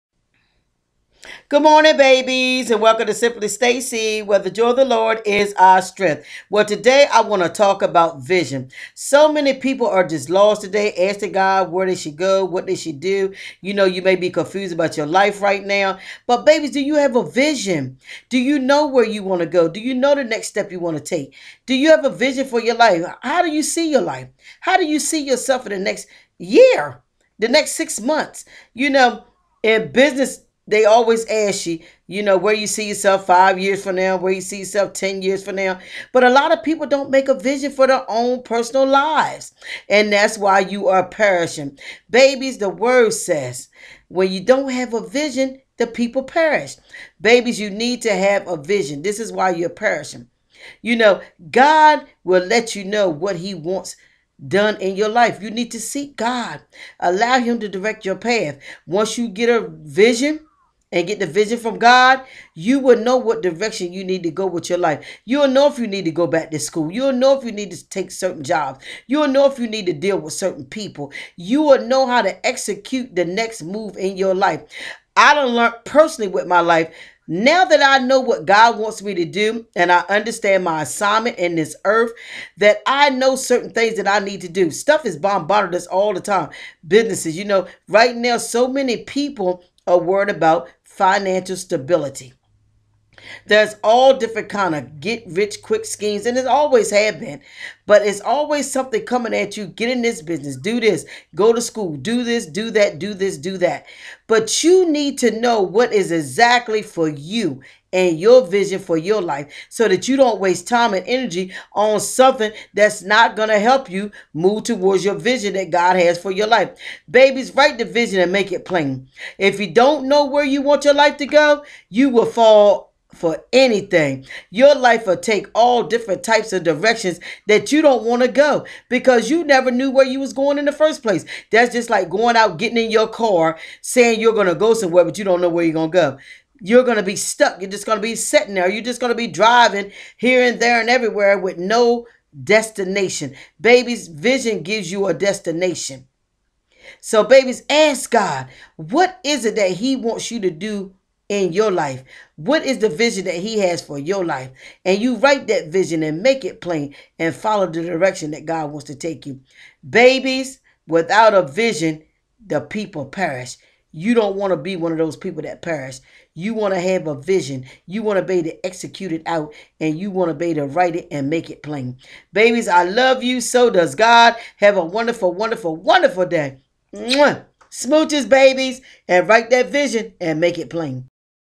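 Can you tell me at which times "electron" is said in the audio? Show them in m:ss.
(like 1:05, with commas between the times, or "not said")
not said.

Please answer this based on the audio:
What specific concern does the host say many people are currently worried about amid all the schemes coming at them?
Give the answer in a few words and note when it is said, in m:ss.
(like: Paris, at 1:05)
financial stability, at 1:30.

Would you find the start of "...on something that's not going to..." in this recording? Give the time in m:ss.
1:51.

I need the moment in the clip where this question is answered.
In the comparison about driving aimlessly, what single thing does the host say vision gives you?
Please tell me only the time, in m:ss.
2:25.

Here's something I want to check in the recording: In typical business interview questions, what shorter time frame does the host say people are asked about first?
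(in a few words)
5 years.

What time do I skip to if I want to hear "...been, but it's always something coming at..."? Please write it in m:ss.
1:37.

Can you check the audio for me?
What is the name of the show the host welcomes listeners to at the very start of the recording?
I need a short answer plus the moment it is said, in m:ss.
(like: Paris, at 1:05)
Simply Stacey, at 0:03.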